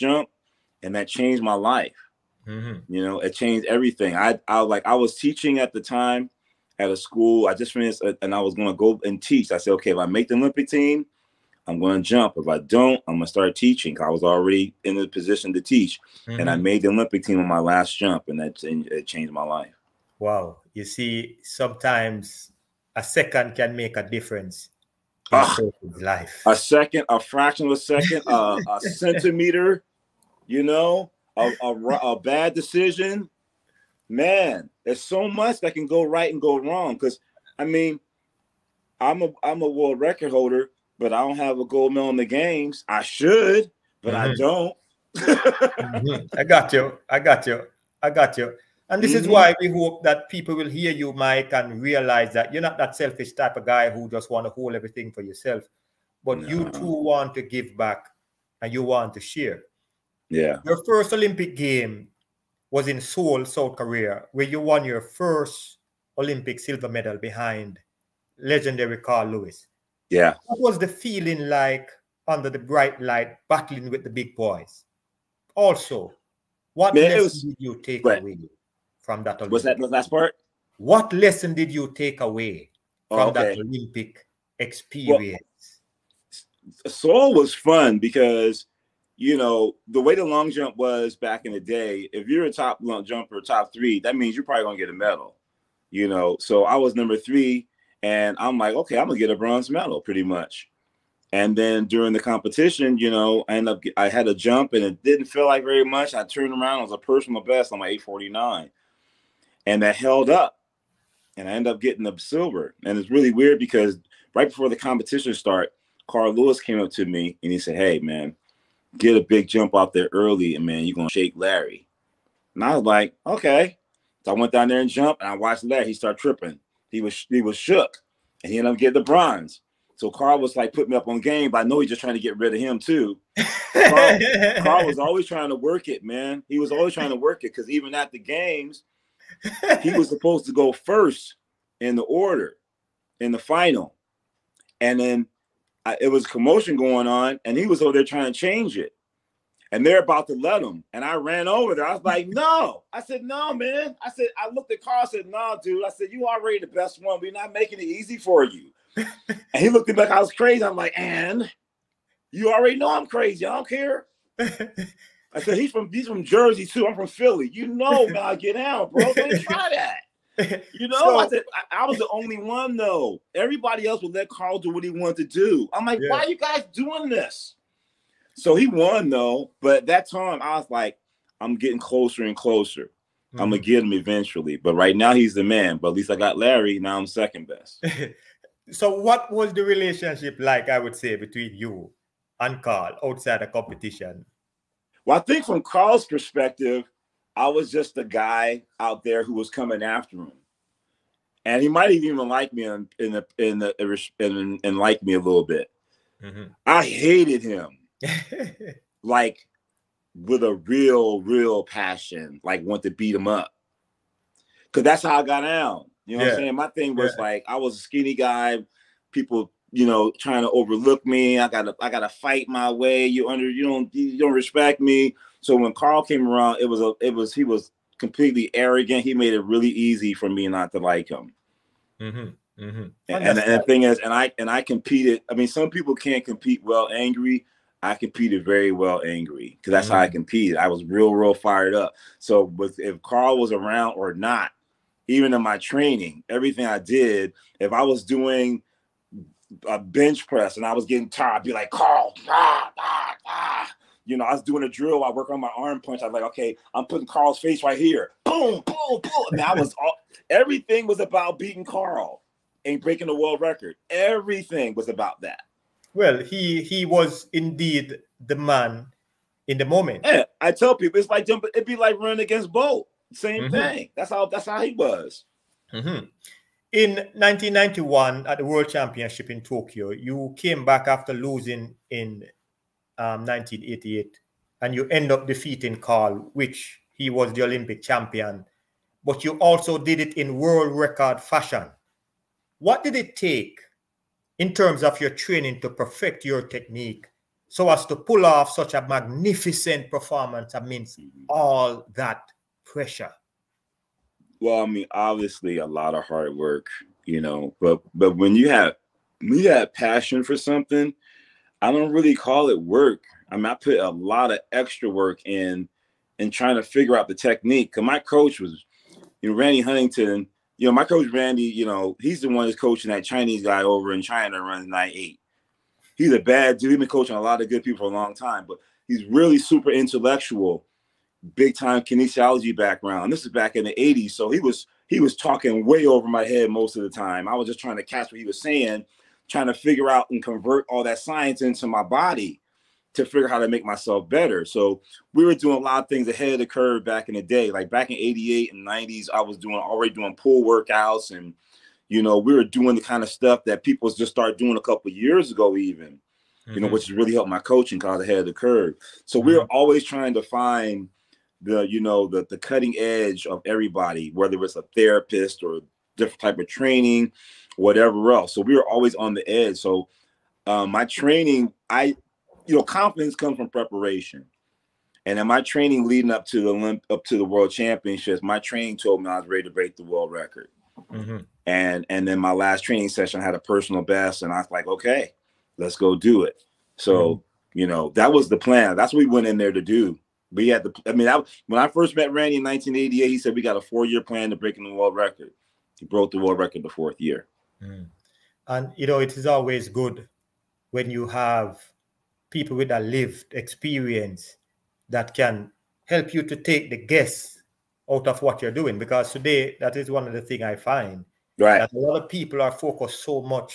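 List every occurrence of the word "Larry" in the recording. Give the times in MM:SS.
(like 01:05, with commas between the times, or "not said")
02:01, 02:05, 03:06.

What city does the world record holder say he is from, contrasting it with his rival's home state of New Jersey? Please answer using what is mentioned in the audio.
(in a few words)
Philly.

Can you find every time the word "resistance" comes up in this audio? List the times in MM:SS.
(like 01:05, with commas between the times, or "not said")
not said.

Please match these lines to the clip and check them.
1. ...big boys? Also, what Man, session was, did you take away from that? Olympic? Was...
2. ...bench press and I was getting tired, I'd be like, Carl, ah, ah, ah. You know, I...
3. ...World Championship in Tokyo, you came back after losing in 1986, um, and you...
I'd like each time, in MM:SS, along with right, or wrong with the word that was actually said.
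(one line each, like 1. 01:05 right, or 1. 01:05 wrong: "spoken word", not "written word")
1. 01:14 wrong: "lesson", not "session"
2. 04:09 right
3. 04:38 wrong: "1988", not "1986".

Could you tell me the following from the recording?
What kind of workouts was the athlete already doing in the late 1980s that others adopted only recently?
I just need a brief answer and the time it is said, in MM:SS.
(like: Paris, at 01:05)
pool workouts, at 05:50.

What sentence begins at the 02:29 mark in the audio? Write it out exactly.
And they're about to let him.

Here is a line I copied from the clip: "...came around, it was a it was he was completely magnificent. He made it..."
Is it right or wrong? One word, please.
wrong.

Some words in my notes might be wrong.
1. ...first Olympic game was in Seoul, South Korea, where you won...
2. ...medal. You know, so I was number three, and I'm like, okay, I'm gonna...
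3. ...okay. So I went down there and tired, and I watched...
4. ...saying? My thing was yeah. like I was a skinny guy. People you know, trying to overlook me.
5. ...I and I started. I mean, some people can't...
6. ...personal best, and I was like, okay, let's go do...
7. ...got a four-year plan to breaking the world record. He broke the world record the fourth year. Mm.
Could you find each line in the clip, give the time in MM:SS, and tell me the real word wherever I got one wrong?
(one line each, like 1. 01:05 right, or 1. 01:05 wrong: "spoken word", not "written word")
1. 01:00 right
2. 01:34 right
3. 02:03 wrong: "jumped", not "tired"
4. 03:36 right
5. 03:54 wrong: "competed", not "started"
6. 06:23 right
7. 06:33 right.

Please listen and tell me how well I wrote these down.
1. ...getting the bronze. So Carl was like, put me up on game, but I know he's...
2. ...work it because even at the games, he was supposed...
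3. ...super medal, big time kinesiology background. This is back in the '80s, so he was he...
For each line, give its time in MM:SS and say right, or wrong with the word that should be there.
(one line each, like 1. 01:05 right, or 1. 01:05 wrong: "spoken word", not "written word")
1. 02:08 right
2. 02:17 right
3. 05:29 wrong: "intellectual", not "medal".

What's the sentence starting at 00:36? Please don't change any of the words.
Because I mean, I'm a I'm a world record holder, but I don't have a gold medal in the games.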